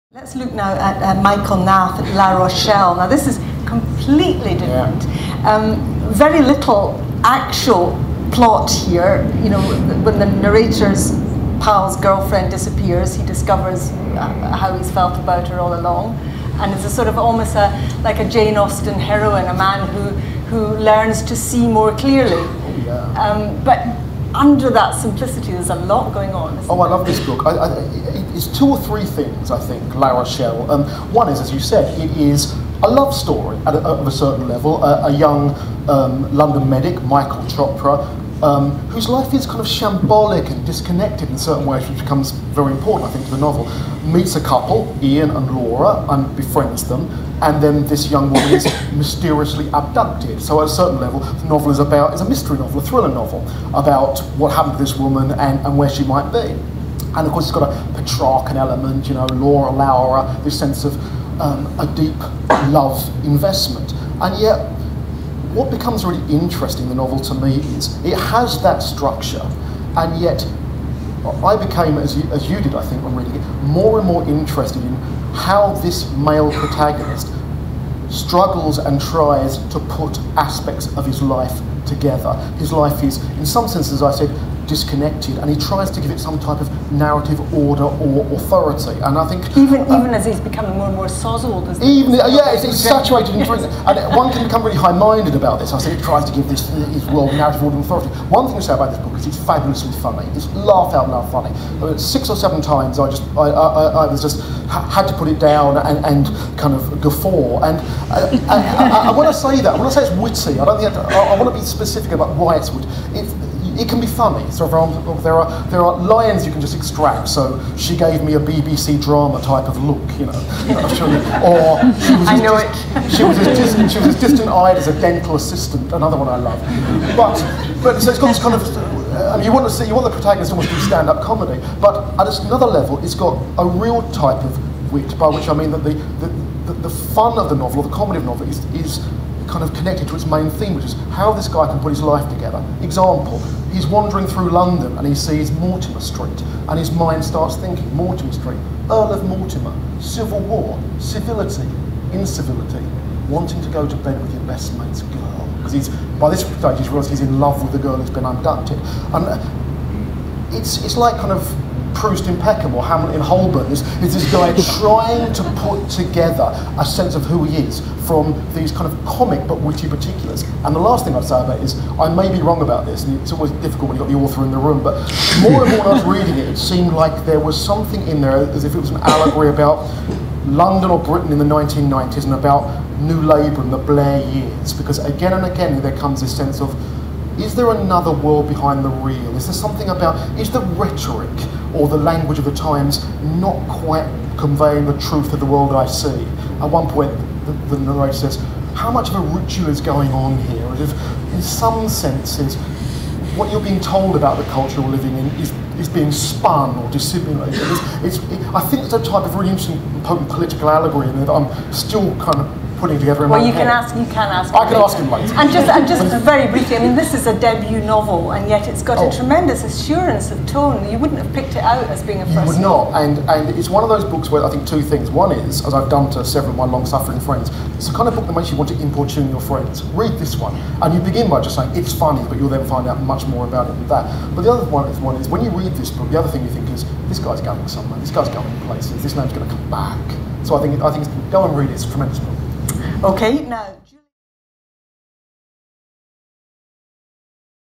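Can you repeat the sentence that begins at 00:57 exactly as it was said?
And of course, it's got a Petrarchan element, you know, Laura Laura, this sense of um, a deep love investment.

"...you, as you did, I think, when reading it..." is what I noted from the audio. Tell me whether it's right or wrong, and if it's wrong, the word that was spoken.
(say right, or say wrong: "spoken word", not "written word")
right.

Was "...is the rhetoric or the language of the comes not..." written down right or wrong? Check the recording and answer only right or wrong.
wrong.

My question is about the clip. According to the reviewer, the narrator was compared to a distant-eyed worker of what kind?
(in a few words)
dental assistant.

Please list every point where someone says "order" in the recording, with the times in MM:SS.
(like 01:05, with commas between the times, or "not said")
01:27, 01:37.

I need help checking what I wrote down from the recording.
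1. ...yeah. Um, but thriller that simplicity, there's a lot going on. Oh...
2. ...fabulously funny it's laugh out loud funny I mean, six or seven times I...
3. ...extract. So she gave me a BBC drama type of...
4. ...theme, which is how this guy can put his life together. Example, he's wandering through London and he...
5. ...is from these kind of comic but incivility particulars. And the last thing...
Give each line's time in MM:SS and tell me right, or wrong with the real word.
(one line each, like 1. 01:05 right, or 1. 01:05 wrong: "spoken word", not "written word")
1. 00:22 wrong: "under", not "thriller"
2. 01:39 right
3. 01:56 right
4. 02:20 right
5. 02:47 wrong: "witty", not "incivility".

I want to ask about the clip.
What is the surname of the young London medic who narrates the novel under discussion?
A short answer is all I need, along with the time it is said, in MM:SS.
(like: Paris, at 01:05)
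Chopra, at 00:37.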